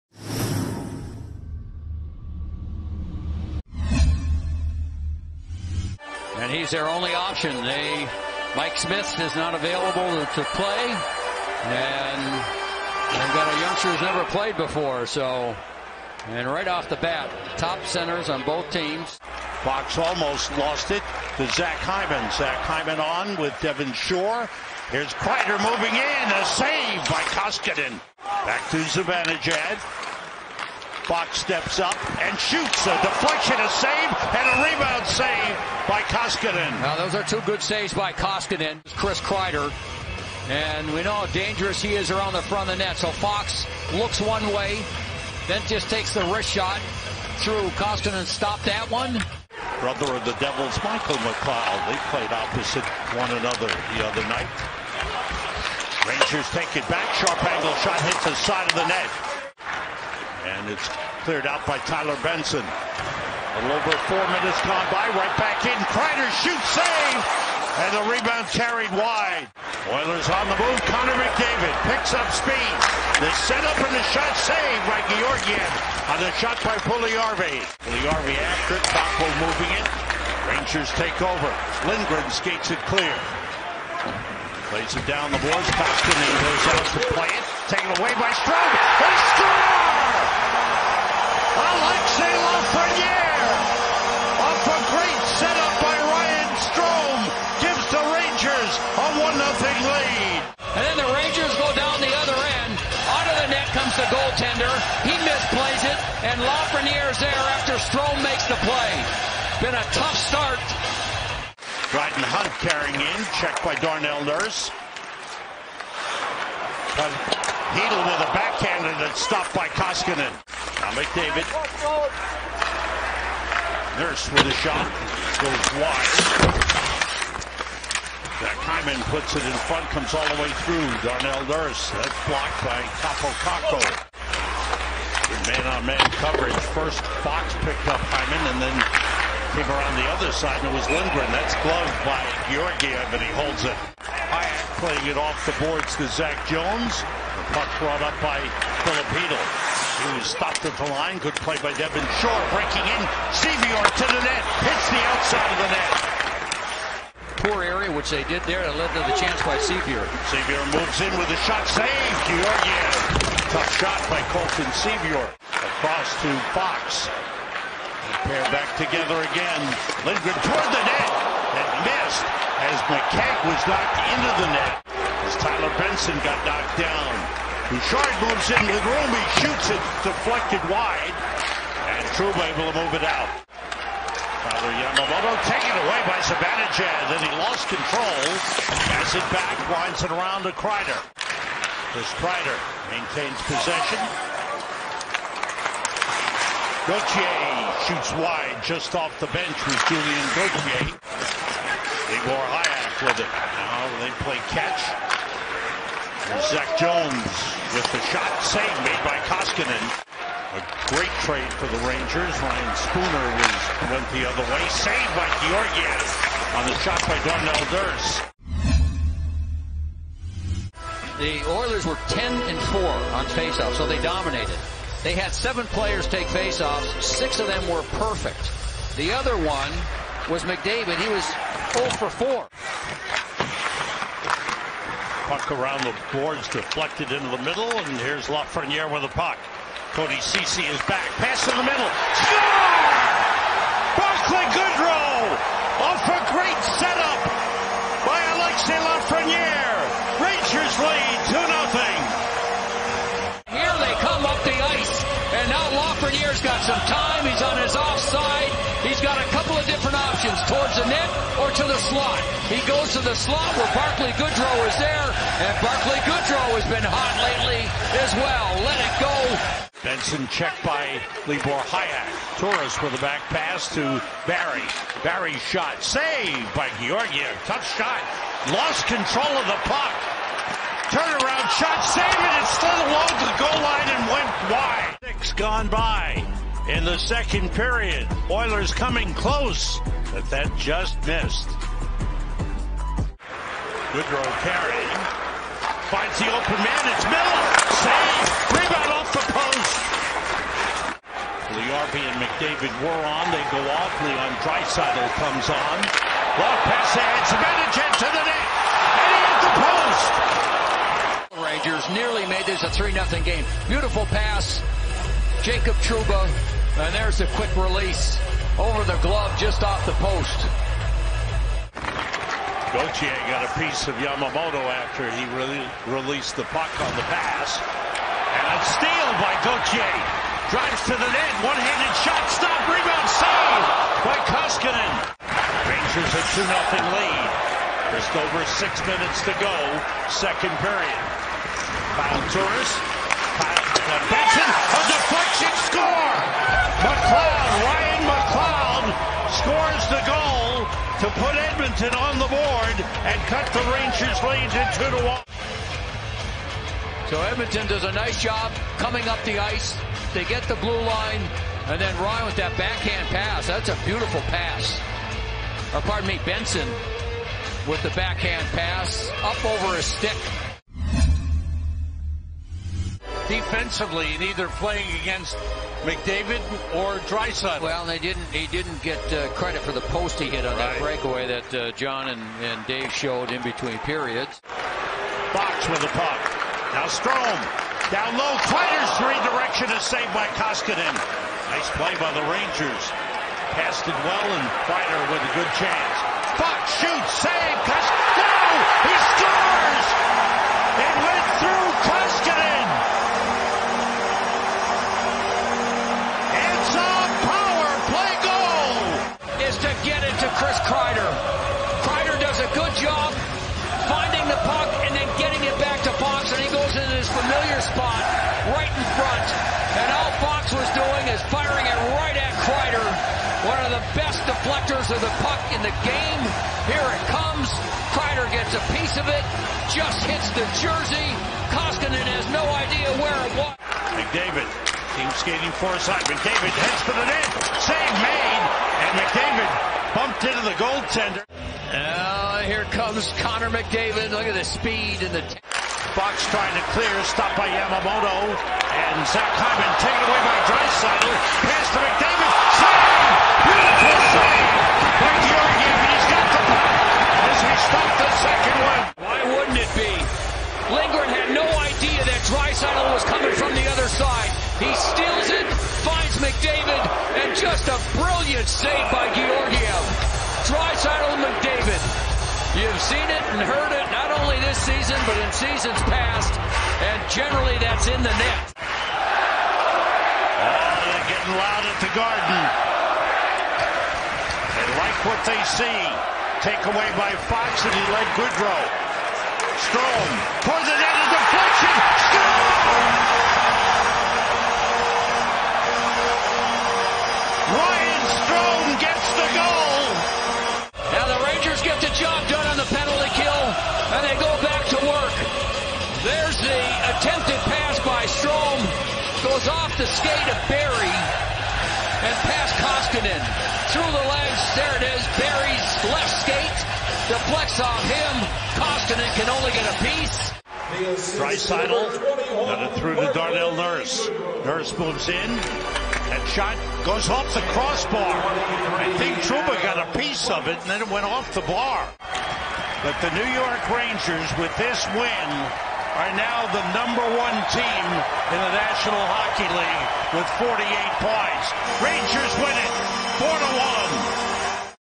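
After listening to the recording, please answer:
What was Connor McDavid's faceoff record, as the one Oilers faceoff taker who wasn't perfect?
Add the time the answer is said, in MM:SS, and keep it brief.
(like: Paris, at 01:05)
0 for 4, at 03:51.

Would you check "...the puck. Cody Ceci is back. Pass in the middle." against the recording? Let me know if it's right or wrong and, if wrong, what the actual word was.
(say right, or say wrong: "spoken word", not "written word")
right.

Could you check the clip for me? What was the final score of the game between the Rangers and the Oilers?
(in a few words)
4 to 1.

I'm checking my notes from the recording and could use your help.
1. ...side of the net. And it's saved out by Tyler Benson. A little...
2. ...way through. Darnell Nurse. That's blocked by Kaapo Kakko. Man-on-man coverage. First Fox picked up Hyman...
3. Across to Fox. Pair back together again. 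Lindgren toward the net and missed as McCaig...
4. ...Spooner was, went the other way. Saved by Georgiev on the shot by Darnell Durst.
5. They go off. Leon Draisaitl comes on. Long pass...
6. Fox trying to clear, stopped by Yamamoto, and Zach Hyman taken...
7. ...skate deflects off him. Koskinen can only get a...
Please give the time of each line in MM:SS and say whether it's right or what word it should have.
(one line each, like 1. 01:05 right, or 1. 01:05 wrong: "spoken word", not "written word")
1. 00:58 wrong: "cleared", not "saved"
2. 02:10 right
3. 02:45 right
4. 03:32 right
5. 05:03 right
6. 07:25 right
7. 08:36 right.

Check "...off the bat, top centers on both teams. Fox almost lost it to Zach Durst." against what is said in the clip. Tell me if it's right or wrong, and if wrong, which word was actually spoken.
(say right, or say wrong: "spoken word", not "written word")
wrong: "Hyman", not "Durst".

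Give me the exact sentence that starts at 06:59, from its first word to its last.
And all Fox was doing is firing it right at Kreider, one of the best deflectors of the puck in the game.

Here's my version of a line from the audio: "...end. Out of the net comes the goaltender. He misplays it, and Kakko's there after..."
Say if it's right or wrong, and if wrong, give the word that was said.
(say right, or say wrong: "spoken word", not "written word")
wrong: "Lafreniere", not "Kakko".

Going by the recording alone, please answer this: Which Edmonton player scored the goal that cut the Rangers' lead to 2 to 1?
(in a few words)
Ryan McLeod.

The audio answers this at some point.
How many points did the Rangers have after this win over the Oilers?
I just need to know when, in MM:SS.
09:00.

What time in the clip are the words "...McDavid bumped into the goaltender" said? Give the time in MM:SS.
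07:19.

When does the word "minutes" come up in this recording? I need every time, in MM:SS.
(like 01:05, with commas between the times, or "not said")
01:04, 05:38.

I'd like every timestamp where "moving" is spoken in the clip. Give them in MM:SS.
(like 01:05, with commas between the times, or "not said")
00:25, 01:19.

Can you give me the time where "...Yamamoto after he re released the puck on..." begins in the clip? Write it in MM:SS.
05:23.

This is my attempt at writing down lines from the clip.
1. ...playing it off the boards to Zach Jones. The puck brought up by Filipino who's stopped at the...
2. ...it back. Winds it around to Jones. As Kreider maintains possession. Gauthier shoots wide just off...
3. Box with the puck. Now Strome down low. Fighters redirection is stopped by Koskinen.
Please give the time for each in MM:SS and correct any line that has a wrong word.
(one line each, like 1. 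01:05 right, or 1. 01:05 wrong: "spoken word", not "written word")
1. 02:24 right
2. 03:09 wrong: "Kreider", not "Jones"
3. 06:25 wrong: "saved", not "stopped".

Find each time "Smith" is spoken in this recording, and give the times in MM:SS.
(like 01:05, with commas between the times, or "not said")
00:08.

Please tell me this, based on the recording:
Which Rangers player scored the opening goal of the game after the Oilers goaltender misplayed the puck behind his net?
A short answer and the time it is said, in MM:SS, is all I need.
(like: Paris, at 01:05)
Alexis Lafreniere, at 01:32.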